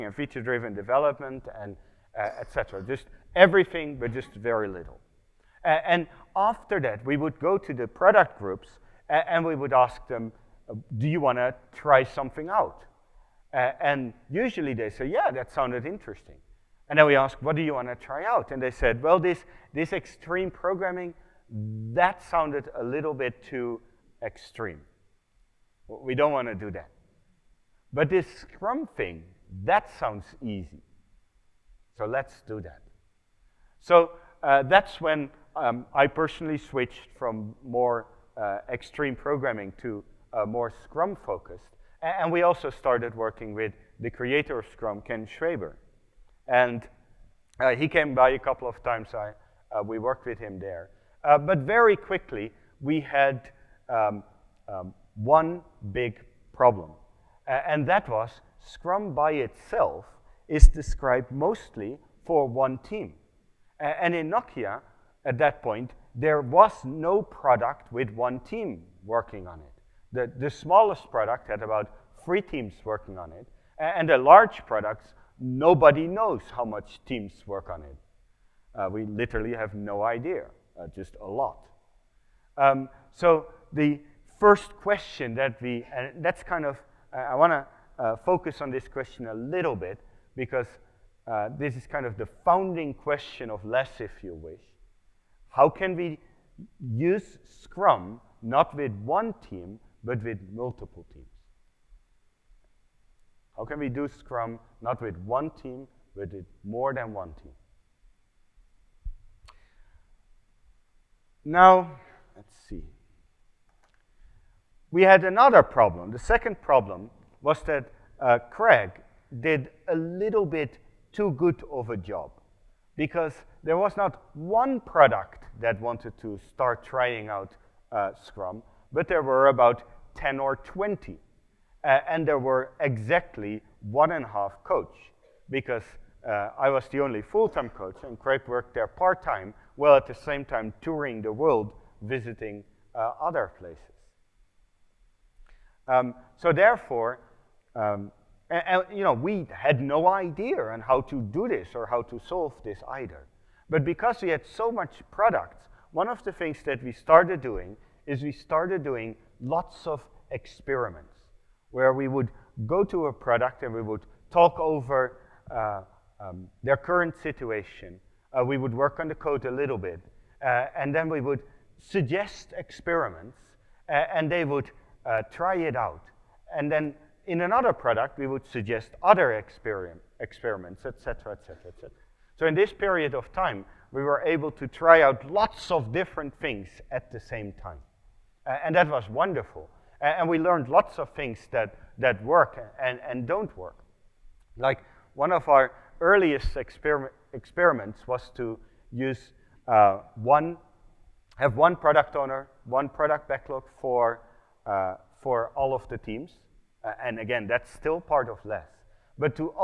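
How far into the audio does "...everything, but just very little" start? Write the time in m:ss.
0:03.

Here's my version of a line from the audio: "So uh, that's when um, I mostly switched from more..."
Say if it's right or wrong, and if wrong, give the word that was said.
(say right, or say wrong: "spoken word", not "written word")
wrong: "personally", not "mostly".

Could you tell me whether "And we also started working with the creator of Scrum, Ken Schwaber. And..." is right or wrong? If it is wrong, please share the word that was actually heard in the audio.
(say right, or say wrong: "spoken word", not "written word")
right.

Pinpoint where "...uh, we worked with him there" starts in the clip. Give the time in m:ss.
0:49.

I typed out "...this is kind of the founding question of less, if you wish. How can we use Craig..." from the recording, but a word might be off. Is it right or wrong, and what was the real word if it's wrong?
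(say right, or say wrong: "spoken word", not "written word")
wrong: "Scrum", not "Craig".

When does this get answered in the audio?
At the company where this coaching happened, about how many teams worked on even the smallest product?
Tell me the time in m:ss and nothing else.
1:11.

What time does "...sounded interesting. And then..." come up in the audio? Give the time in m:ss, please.
0:15.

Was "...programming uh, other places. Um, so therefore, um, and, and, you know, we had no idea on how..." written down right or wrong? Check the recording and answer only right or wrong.
wrong.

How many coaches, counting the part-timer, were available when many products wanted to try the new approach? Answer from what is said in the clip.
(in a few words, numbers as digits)
1.5.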